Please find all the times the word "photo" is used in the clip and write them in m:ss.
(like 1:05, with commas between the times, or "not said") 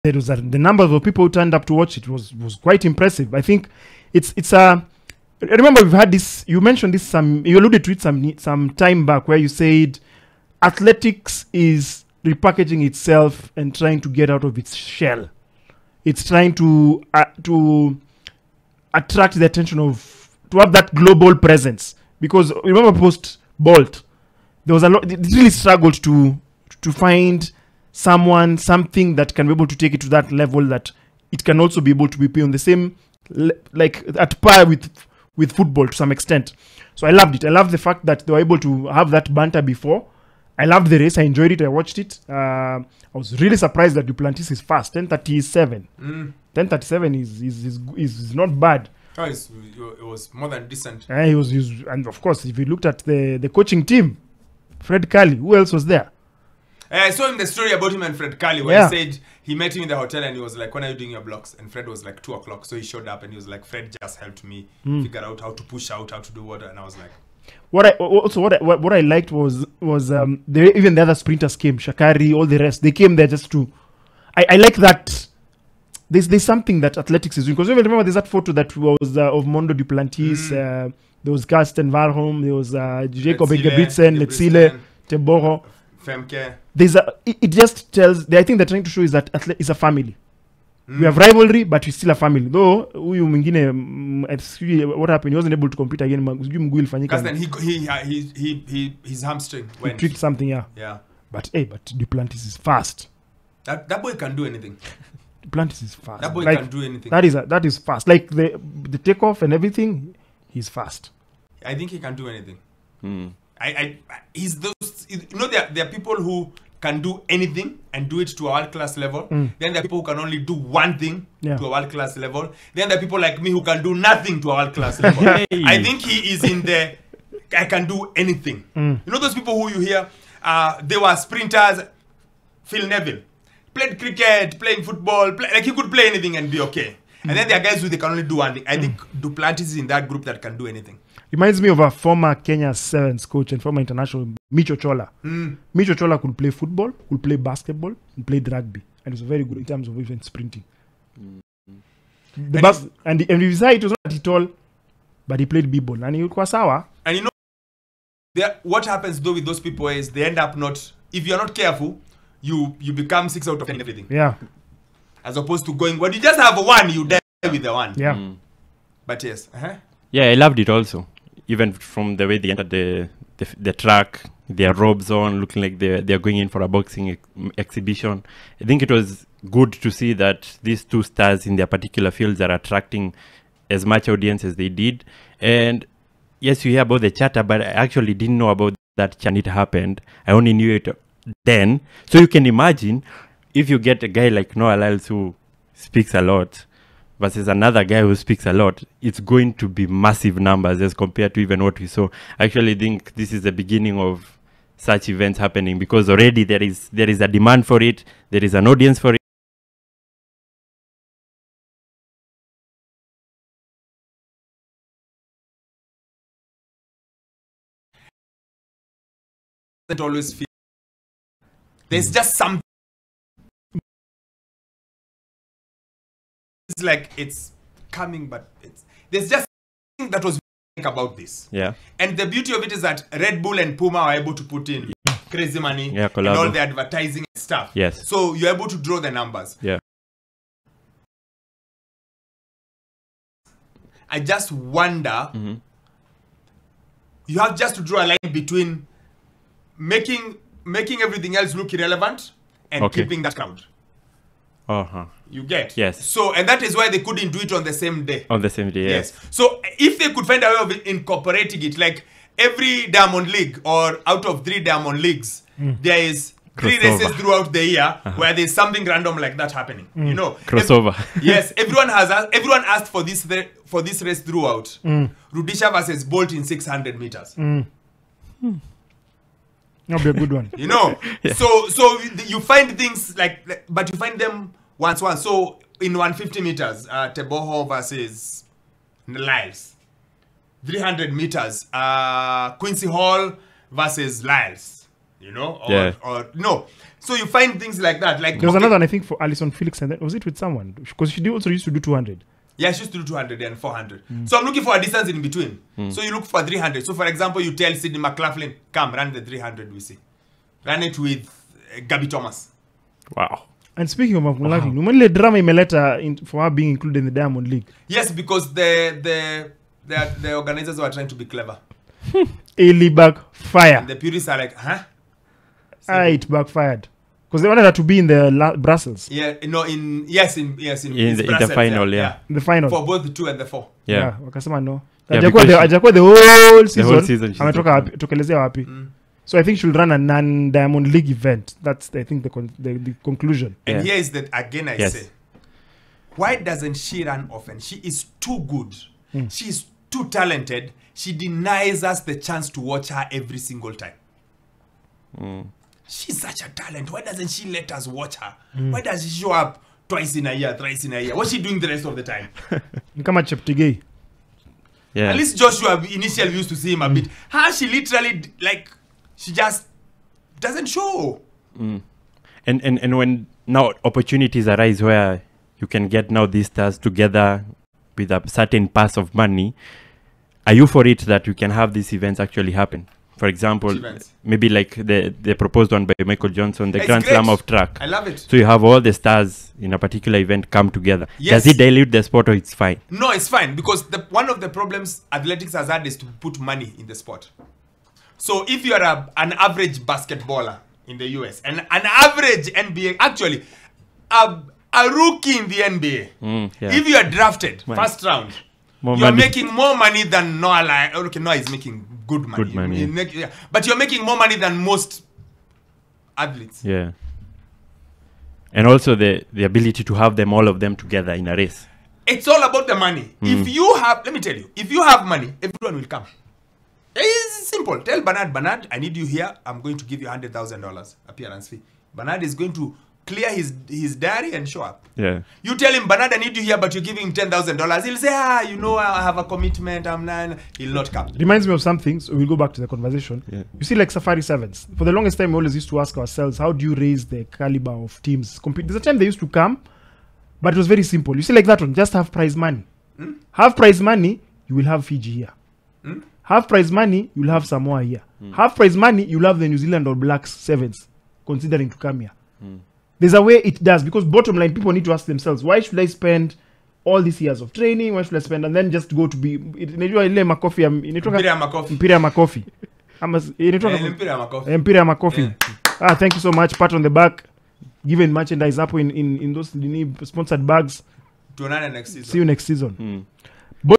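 1:18.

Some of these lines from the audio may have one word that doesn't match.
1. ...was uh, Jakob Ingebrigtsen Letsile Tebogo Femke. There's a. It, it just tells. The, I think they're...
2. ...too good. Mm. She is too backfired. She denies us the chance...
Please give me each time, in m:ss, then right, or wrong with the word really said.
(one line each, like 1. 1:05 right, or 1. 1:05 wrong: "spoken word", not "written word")
1. 1:22 right
2. 5:48 wrong: "talented", not "backfired".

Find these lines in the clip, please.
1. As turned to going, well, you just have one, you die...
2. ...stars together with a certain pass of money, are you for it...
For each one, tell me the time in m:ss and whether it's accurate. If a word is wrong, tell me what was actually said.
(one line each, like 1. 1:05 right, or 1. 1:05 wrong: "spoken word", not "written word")
1. 2:45 wrong: "opposed", not "turned"
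2. 6:16 right.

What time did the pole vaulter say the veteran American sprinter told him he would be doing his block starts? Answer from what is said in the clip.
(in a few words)
2 o'clock.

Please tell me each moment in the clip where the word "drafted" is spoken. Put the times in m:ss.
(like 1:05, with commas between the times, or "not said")
6:47.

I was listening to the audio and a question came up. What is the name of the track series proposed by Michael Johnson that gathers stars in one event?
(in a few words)
Grand Slam of Track.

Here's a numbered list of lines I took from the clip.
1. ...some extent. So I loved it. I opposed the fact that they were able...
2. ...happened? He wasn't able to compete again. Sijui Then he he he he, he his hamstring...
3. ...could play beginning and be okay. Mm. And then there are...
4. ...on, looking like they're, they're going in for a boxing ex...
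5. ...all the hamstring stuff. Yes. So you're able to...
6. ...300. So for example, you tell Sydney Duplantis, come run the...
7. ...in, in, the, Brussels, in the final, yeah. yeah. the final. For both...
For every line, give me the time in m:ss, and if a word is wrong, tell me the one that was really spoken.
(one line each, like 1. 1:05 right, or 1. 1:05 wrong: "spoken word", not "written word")
1. 0:35 wrong: "loved", not "opposed"
2. 1:35 right
3. 2:15 wrong: "anything", not "beginning"
4. 2:55 right
5. 3:56 wrong: "advertising", not "hamstring"
6. 5:06 wrong: "McLaughlin", not "Duplantis"
7. 5:30 right.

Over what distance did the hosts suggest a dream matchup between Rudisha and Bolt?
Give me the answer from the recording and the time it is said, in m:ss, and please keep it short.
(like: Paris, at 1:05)
600 meters, at 4:36.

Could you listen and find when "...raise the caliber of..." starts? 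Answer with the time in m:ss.
7:26.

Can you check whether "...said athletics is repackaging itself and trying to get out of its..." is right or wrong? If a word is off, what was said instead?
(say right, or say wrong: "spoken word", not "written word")
right.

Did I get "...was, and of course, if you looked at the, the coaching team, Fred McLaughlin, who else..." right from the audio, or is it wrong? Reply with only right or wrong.
wrong.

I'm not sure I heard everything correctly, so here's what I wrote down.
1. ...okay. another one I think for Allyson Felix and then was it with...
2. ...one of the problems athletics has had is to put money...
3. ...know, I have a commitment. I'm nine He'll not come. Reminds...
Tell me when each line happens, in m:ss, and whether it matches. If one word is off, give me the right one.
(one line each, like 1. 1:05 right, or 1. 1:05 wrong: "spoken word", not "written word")
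1. 4:58 right
2. 6:34 right
3. 7:18 right.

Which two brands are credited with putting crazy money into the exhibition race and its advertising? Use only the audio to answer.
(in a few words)
Red Bull and Puma.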